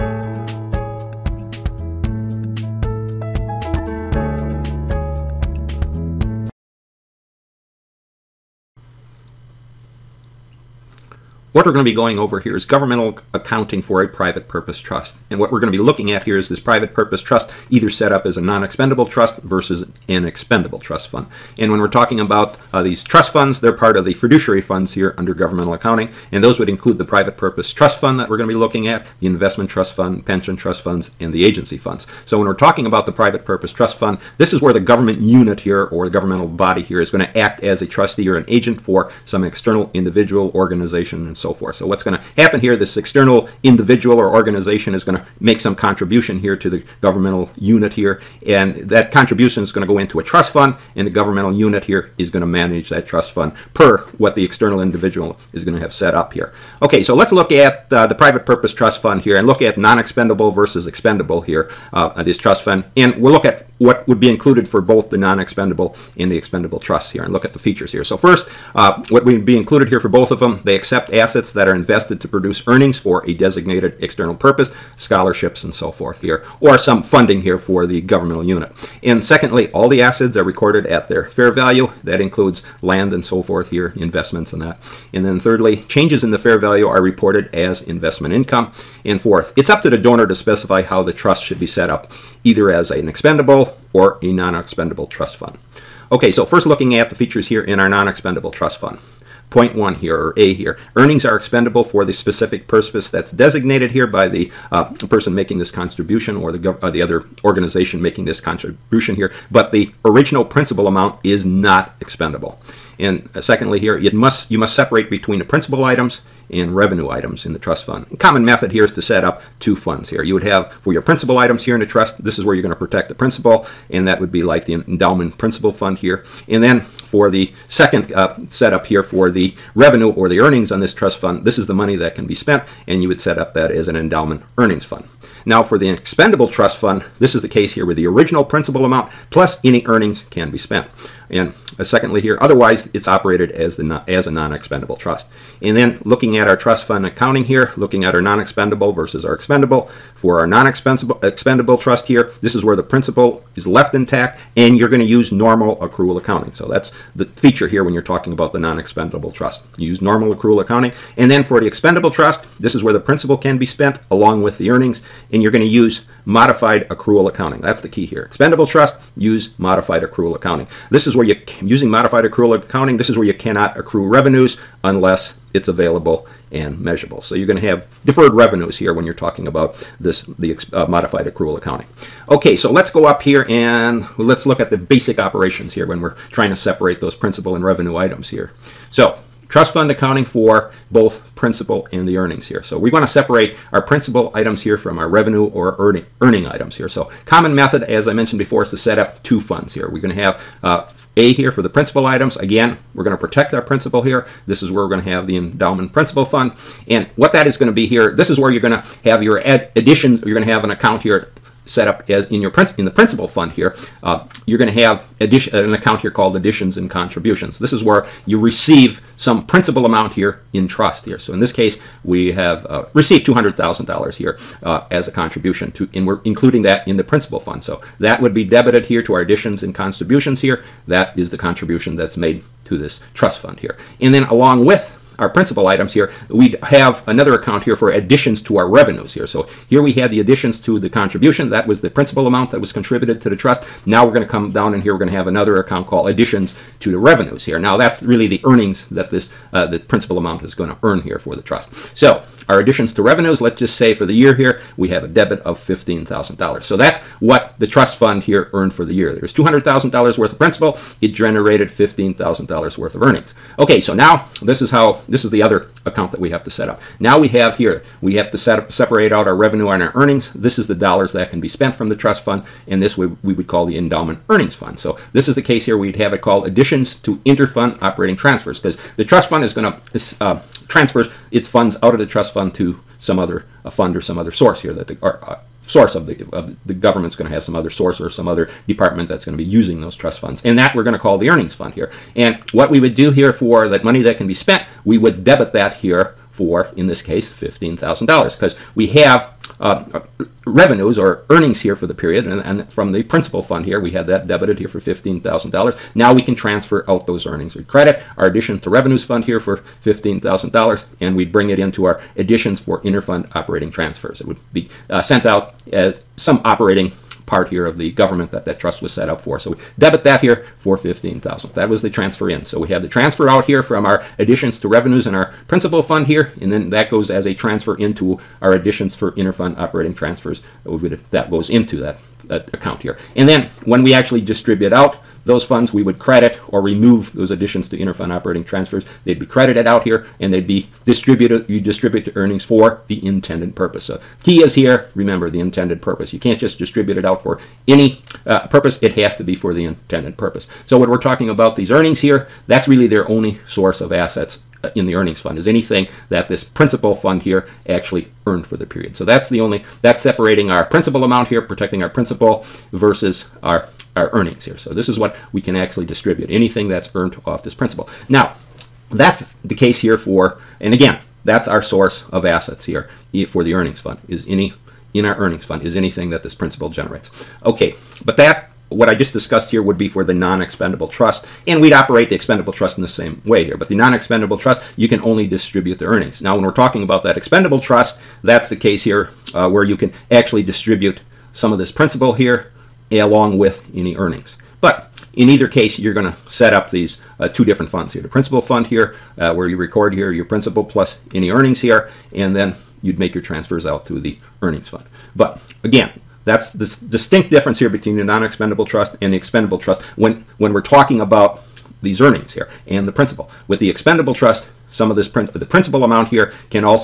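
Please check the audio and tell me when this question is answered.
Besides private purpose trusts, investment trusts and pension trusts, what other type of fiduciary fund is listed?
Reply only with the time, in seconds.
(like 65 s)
31 s.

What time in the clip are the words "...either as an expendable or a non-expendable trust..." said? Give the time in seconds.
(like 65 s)
92 s.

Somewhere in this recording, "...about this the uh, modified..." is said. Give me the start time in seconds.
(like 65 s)
179 s.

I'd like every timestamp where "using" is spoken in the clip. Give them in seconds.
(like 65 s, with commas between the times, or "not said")
171 s, 289 s.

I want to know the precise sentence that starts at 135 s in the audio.
Now for the expendable trust fund, this is the case here where the original principal amount plus any earnings can be spent.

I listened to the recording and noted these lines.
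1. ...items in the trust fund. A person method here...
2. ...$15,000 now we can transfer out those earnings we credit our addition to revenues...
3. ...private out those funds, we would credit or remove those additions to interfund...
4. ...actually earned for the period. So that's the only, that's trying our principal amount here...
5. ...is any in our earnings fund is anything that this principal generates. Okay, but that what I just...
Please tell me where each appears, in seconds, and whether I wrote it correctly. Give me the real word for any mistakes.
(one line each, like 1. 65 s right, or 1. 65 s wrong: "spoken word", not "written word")
1. 117 s wrong: "common", not "person"
2. 304 s right
3. 334 s wrong: "distribute", not "private"
4. 357 s wrong: "separating", not "trying"
5. 374 s right.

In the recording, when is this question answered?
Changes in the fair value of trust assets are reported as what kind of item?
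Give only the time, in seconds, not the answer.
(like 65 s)
87 s.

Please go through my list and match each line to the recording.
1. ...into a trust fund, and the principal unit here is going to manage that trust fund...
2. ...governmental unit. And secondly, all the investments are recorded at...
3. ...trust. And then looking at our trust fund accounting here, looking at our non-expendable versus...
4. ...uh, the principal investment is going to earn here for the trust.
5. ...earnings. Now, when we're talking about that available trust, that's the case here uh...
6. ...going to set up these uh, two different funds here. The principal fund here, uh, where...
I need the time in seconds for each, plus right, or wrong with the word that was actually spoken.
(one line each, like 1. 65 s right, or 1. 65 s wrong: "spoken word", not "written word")
1. 49 s wrong: "governmental", not "principal"
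2. 78 s wrong: "assets", not "investments"
3. 144 s right
4. 249 s wrong: "amount", not "investment"
5. 385 s wrong: "expendable", not "available"
6. 395 s right.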